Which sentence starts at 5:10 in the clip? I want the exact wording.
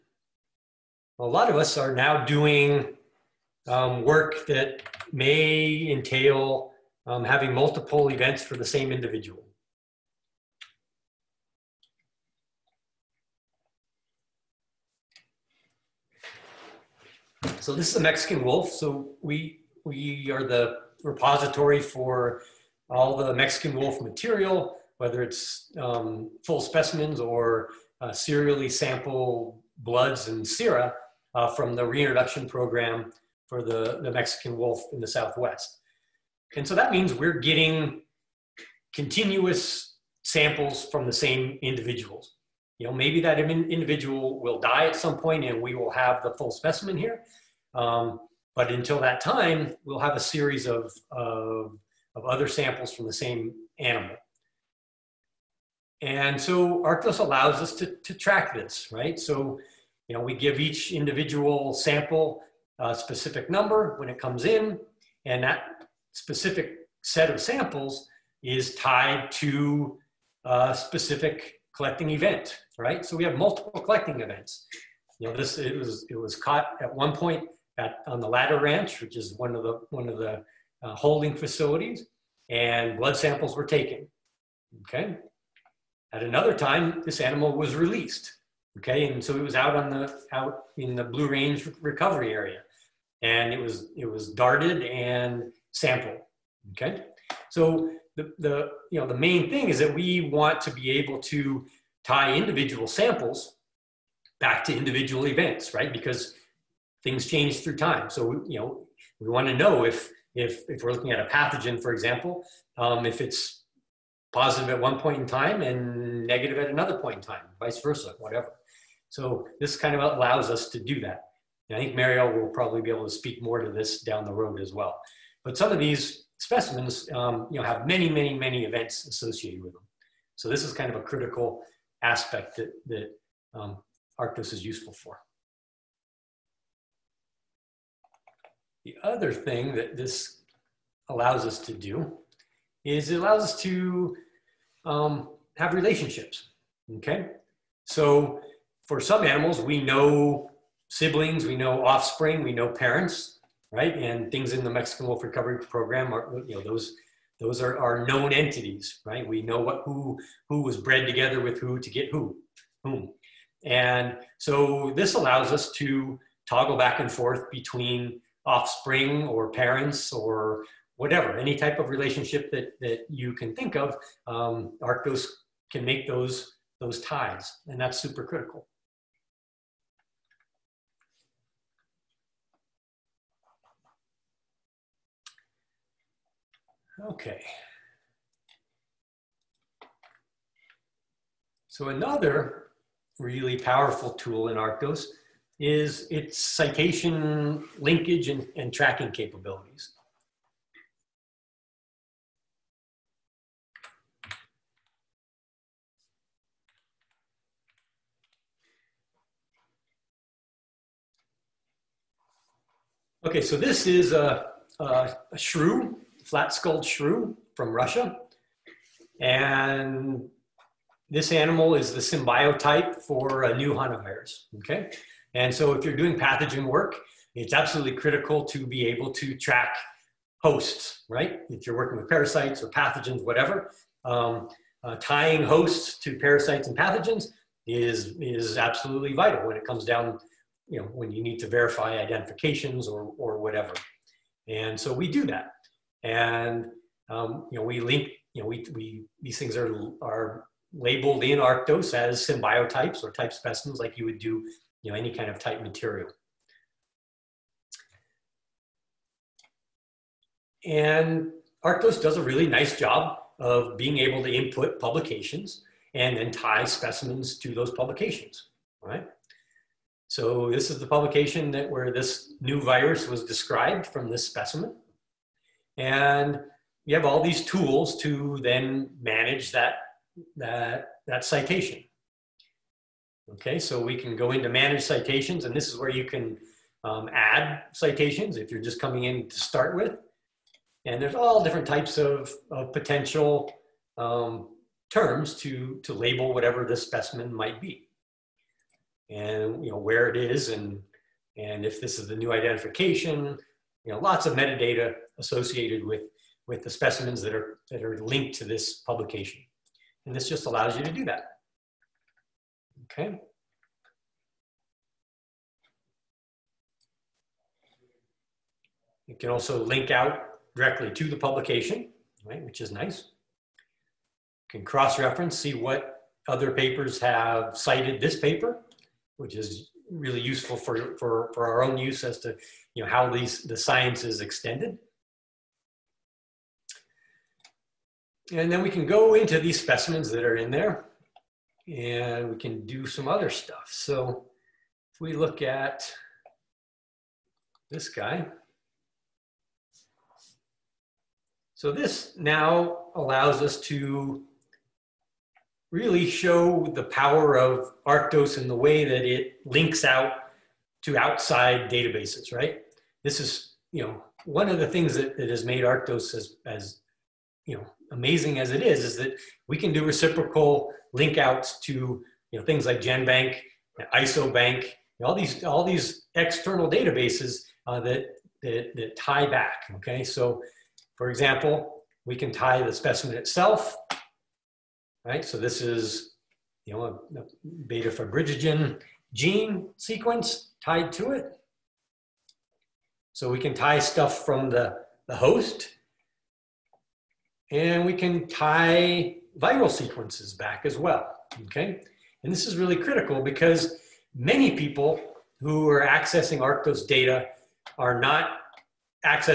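And this just allows you to do that.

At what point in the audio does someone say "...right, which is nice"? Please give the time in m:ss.
5:22.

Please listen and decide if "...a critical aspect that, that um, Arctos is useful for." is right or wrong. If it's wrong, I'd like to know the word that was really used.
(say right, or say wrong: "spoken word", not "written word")
right.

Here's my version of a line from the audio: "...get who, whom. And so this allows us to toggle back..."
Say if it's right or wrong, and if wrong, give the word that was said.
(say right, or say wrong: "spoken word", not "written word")
right.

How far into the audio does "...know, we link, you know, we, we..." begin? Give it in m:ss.
4:07.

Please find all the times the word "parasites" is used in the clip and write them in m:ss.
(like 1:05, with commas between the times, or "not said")
3:52, 3:56.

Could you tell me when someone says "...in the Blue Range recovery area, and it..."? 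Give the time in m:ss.
1:30.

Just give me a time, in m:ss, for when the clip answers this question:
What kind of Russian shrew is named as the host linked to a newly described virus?
3:36.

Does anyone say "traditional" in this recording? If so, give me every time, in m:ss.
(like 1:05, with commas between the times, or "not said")
not said.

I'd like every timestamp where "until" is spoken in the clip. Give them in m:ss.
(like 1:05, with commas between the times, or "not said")
0:48.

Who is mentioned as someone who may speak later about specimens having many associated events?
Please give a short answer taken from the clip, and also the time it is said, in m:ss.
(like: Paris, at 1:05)
Mariel, at 2:01.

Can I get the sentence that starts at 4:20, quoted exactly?
And Arctos does a really nice job of being able to input publications and then tie specimens to those publications, right?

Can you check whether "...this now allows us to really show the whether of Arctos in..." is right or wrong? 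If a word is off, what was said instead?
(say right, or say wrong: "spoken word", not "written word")
wrong: "power", not "whether".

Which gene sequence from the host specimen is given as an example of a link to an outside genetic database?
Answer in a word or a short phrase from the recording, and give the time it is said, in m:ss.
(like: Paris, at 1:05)
beta fibrinogen, at 6:27.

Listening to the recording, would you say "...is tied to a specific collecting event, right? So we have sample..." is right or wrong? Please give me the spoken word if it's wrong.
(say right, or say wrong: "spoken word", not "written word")
wrong: "multiple", not "sample".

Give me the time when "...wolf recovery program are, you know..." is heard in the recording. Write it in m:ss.
2:35.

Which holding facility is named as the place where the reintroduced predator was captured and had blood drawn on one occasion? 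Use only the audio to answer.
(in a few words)
Ladder Ranch.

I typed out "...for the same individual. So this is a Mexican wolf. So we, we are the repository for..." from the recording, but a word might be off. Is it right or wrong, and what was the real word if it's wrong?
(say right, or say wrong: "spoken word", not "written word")
right.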